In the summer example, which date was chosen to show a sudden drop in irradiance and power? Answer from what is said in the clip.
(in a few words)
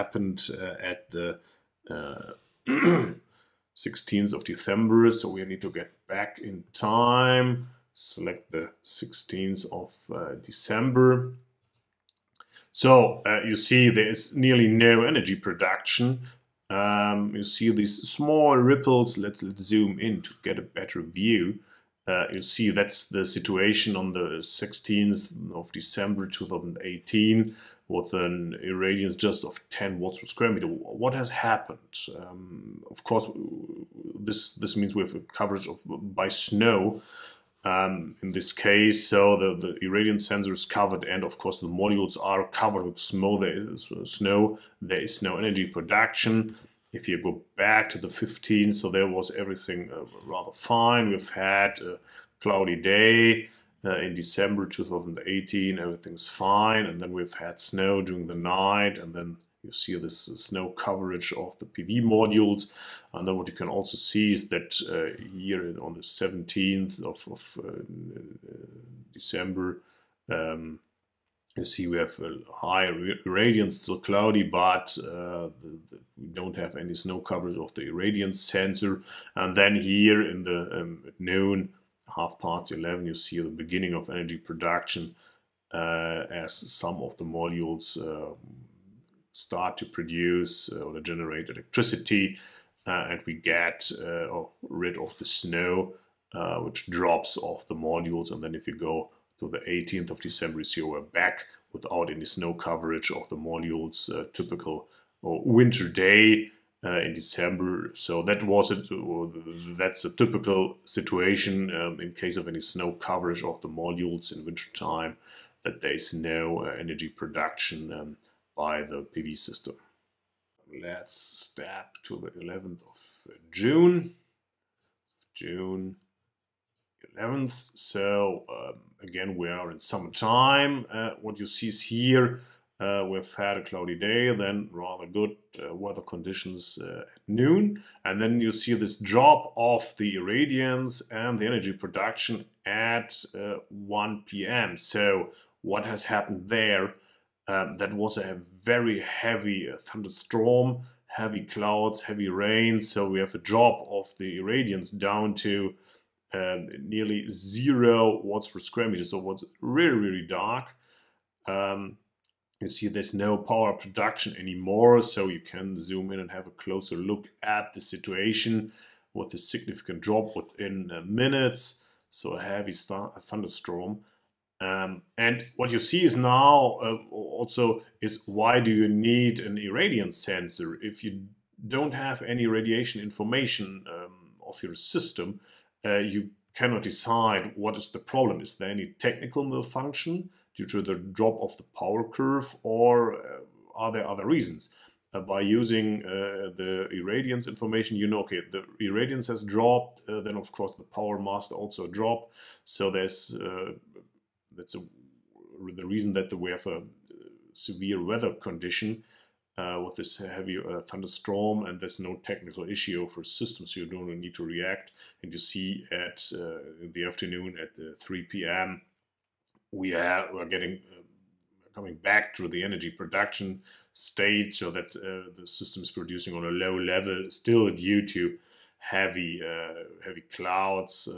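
June 11.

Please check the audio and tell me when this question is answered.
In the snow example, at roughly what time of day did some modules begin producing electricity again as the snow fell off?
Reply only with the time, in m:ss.
1:22.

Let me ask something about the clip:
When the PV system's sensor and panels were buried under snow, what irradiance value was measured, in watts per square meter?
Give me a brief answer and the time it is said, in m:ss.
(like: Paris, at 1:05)
10, at 0:29.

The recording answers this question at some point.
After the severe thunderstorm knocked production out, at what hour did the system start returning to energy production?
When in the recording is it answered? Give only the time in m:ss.
3:37.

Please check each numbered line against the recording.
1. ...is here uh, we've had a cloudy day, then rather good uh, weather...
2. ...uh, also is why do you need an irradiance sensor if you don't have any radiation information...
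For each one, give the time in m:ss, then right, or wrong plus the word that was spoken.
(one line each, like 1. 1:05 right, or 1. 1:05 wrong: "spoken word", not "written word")
1. 2:11 right
2. 2:56 right.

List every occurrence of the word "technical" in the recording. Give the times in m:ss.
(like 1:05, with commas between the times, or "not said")
3:08, 3:32.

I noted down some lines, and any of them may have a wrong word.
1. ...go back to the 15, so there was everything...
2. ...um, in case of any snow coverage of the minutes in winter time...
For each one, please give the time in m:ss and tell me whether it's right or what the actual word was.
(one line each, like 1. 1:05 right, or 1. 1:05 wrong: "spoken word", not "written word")
1. 0:47 right
2. 1:51 wrong: "modules", not "minutes".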